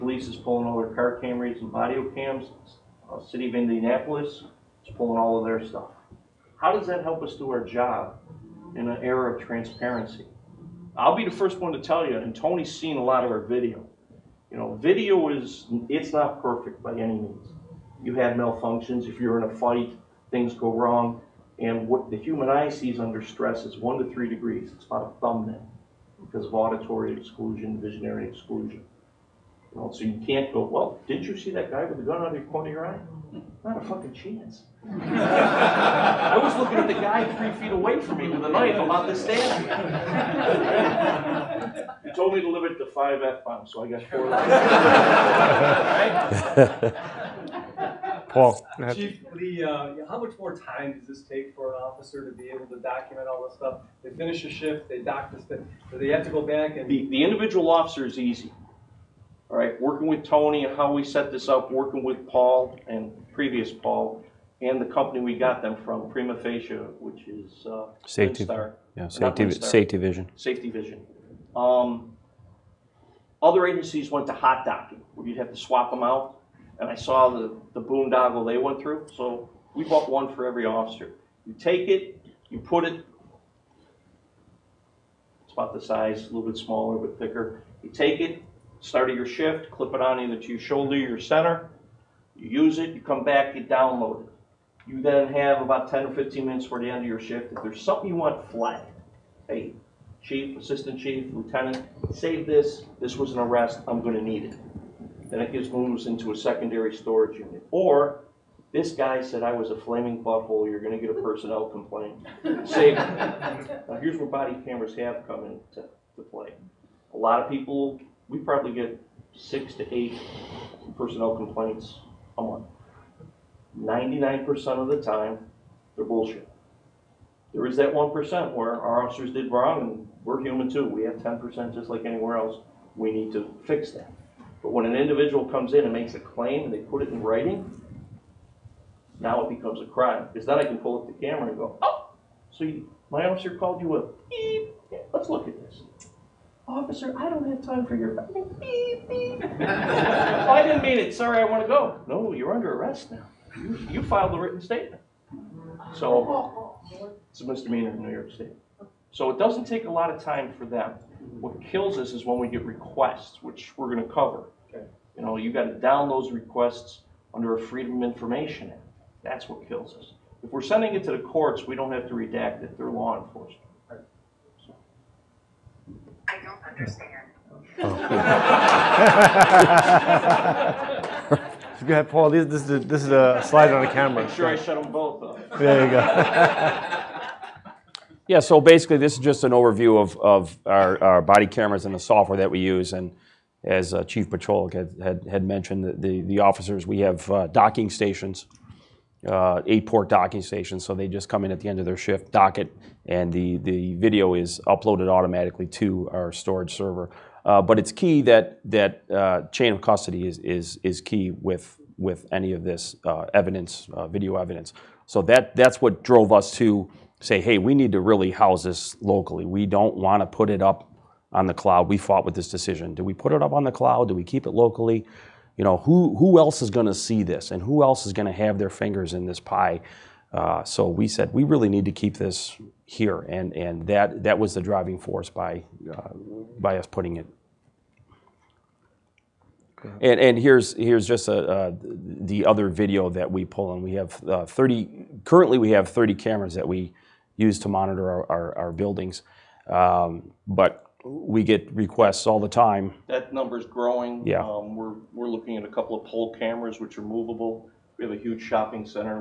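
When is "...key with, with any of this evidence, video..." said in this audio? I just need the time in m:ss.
3:31.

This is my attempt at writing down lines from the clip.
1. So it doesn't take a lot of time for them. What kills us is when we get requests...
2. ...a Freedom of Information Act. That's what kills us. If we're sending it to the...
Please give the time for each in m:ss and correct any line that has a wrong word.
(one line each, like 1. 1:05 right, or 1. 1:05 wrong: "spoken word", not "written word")
1. 2:39 right
2. 2:47 right.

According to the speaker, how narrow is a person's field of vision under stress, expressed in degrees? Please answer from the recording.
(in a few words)
1 to 3 degrees.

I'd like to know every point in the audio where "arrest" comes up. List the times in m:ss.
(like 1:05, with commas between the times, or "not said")
1:43, 2:32.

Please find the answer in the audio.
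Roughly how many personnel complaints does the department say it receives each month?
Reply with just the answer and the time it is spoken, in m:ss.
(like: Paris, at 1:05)
6 to 8, at 1:59.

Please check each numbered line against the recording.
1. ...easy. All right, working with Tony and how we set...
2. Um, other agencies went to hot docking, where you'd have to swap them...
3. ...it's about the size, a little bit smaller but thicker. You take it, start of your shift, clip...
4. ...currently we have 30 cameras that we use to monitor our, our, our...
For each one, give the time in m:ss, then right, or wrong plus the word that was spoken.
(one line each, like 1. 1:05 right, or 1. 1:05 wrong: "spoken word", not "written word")
1. 0:58 right
2. 1:11 right
3. 1:25 right
4. 4:05 right.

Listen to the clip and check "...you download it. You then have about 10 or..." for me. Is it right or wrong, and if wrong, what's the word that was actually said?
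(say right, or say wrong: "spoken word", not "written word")
right.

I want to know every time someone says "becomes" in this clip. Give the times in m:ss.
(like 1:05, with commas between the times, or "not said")
2:19.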